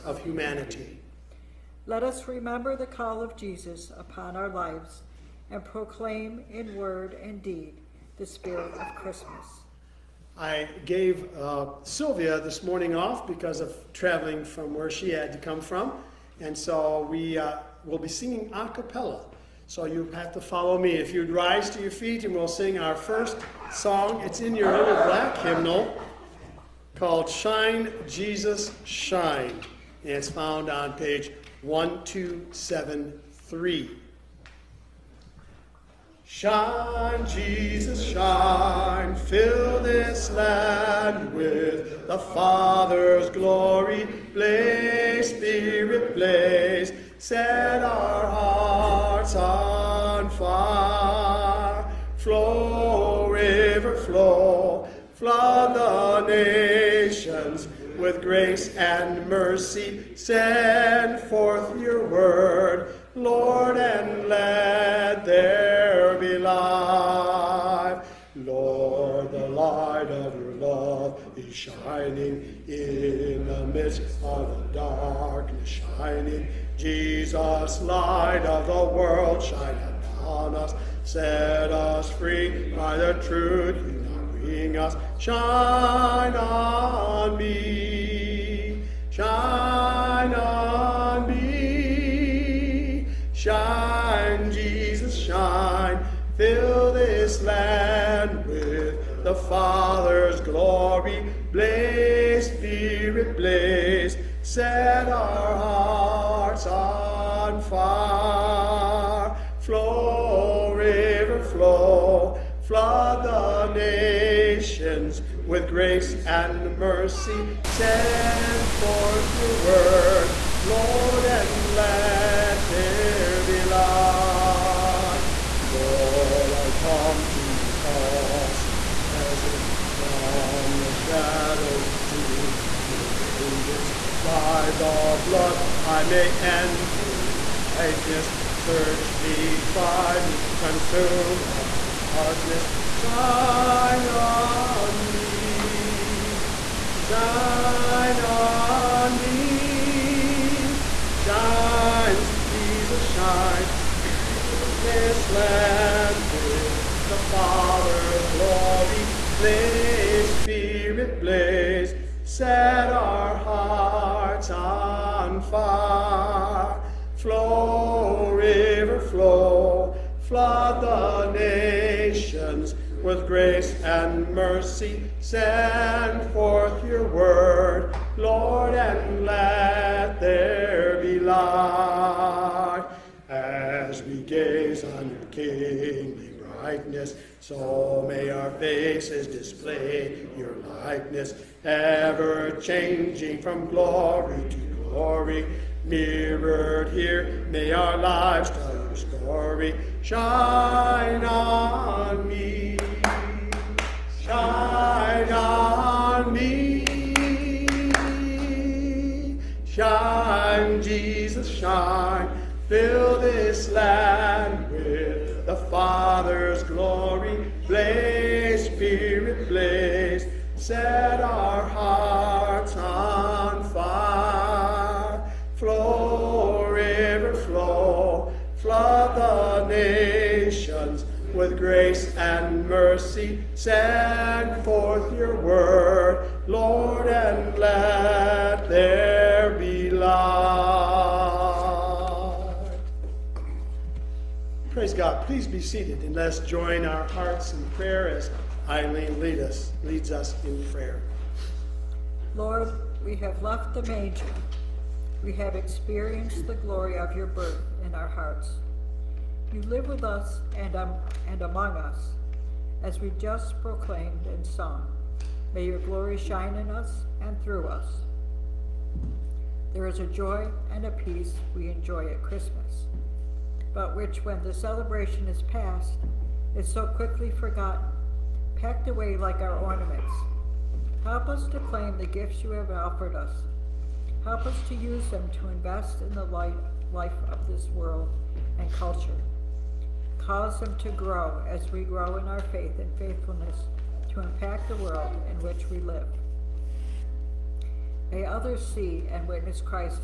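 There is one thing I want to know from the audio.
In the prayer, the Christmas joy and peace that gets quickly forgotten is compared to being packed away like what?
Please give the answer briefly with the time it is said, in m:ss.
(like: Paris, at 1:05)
Ornaments, at 4:39.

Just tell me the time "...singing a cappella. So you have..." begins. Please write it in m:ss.
0:18.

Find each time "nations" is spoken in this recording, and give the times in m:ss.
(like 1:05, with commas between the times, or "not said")
0:56, 1:53, 2:51, 3:49.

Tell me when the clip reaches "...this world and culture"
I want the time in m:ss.
4:47.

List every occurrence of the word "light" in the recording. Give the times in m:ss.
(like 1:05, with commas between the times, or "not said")
1:17, 2:03, 3:01.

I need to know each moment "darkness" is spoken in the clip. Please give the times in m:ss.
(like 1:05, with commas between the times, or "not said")
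1:14, 2:22.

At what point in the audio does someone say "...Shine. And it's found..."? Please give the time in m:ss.
0:28.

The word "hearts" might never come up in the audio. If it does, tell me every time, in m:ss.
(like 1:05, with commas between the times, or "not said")
0:48, 1:45, 2:43, 3:41, 4:07, 4:18.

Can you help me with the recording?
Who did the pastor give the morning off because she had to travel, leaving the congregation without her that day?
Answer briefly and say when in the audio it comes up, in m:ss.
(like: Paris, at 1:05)
Sylvia, at 0:11.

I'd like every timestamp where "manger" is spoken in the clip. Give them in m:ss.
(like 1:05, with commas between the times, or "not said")
4:13.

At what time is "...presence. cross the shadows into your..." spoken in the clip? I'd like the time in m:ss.
2:08.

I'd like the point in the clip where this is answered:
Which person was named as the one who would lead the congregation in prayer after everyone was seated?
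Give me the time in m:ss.
4:08.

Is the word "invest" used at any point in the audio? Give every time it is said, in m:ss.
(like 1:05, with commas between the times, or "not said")
4:45.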